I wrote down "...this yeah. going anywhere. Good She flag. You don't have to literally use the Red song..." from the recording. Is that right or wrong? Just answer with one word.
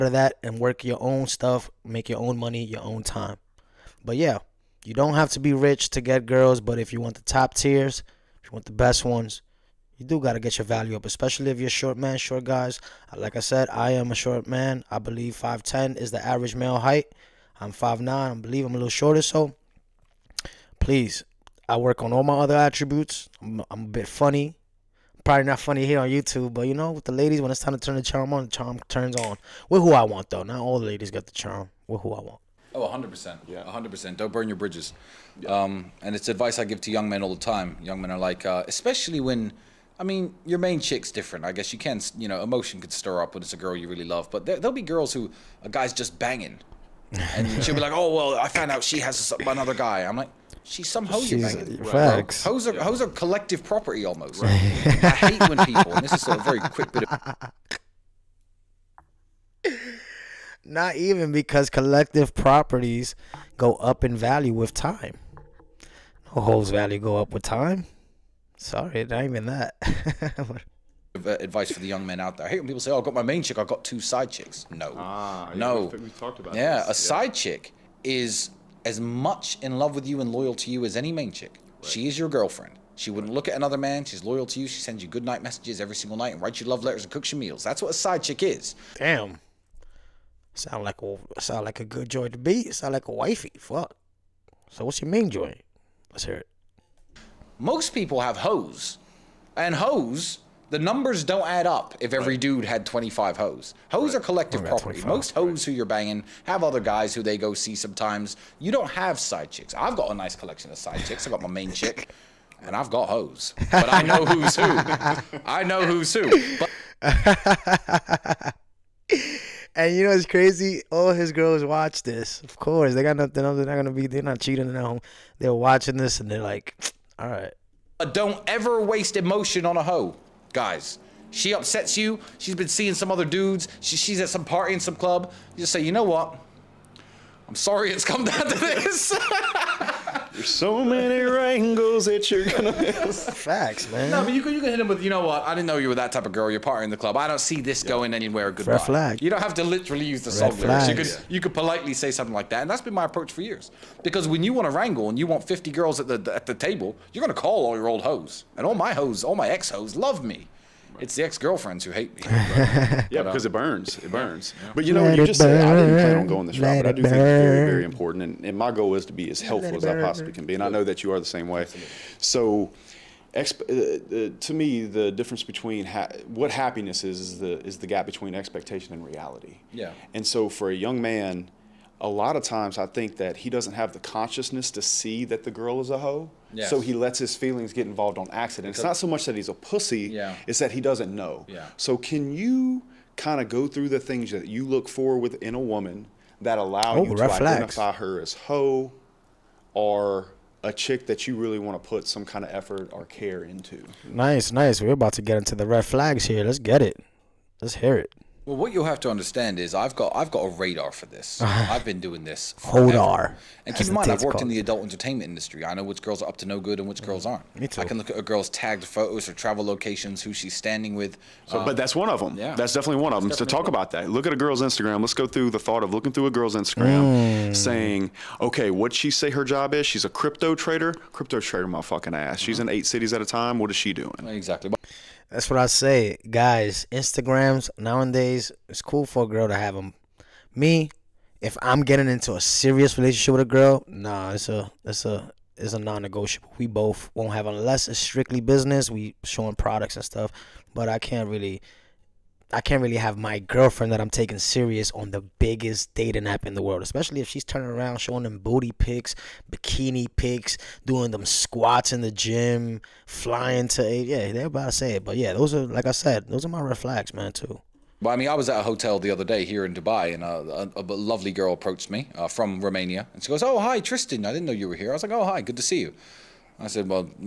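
wrong.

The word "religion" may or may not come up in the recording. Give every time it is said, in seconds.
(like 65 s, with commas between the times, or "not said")
not said.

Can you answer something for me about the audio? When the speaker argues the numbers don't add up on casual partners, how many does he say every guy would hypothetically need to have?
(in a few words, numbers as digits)
25.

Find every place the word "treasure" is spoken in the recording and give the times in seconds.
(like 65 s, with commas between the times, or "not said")
not said.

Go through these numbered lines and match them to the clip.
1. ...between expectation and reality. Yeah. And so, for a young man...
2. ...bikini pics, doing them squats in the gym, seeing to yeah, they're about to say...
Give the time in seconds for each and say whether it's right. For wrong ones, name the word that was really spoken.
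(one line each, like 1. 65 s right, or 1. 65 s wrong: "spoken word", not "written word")
1. 178 s right
2. 259 s wrong: "flying", not "seeing".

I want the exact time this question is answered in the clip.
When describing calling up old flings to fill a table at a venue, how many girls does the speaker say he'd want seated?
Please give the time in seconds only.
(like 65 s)
155 s.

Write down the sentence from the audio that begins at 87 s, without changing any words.
That's what a side chick is.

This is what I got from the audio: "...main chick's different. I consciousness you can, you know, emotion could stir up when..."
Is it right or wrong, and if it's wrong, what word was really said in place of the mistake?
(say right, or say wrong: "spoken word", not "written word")
wrong: "guess", not "consciousness".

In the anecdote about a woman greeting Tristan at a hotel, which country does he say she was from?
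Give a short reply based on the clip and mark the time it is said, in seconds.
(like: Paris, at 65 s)
Romania, at 272 s.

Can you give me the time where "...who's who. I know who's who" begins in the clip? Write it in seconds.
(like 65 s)
114 s.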